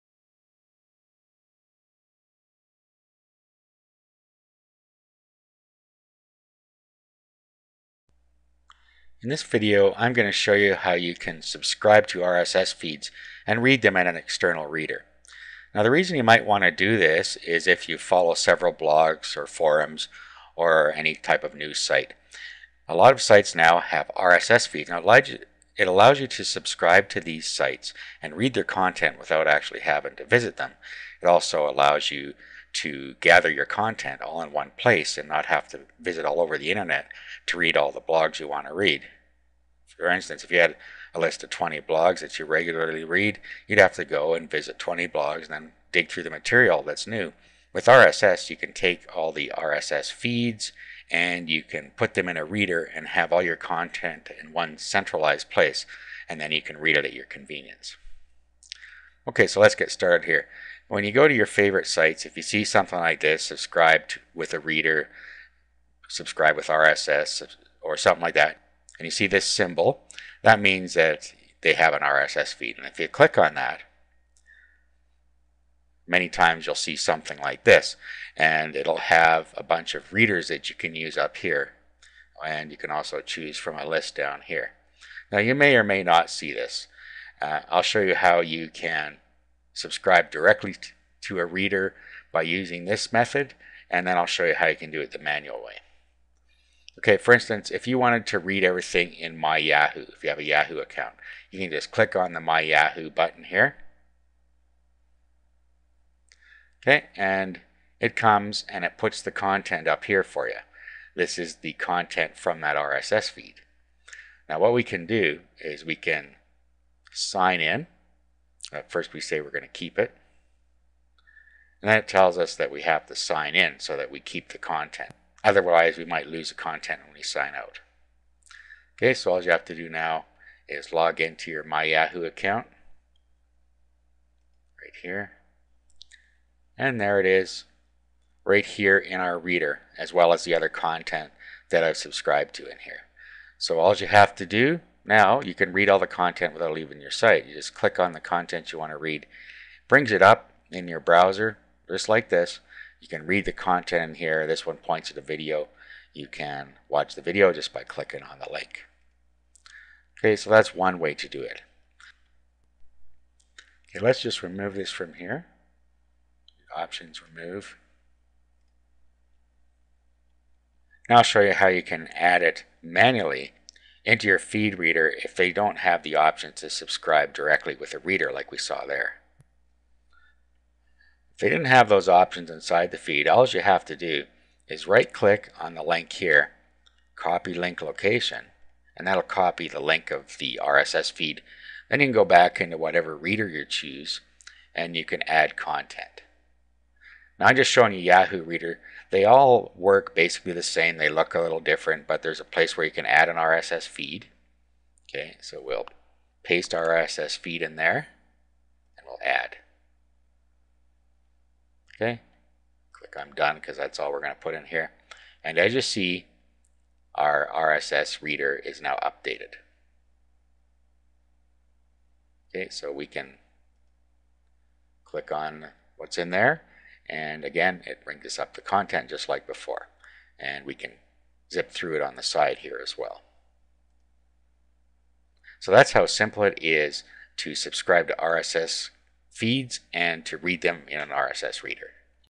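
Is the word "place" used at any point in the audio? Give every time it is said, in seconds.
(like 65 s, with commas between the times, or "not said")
34 s, 55 s, 202 s.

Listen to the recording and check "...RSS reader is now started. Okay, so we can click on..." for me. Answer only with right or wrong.
wrong.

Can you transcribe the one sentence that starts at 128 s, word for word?
Okay, so all you have to do now is log into your My Yahoo account right here.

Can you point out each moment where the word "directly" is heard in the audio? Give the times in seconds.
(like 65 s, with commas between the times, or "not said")
90 s, 177 s.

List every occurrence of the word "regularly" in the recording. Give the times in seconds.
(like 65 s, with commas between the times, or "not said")
42 s.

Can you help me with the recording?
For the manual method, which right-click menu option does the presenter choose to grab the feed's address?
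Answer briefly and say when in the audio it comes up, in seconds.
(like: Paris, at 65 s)
copy link location, at 187 s.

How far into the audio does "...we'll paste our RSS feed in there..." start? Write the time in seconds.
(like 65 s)
205 s.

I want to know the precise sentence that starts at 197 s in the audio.
Now I'm just showing you Yahoo Reader.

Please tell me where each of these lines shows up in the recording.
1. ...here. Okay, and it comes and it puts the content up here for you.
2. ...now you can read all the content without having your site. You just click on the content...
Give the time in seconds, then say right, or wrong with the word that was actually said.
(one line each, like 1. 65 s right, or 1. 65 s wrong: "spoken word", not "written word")
1. 103 s right
2. 145 s wrong: "leaving", not "having".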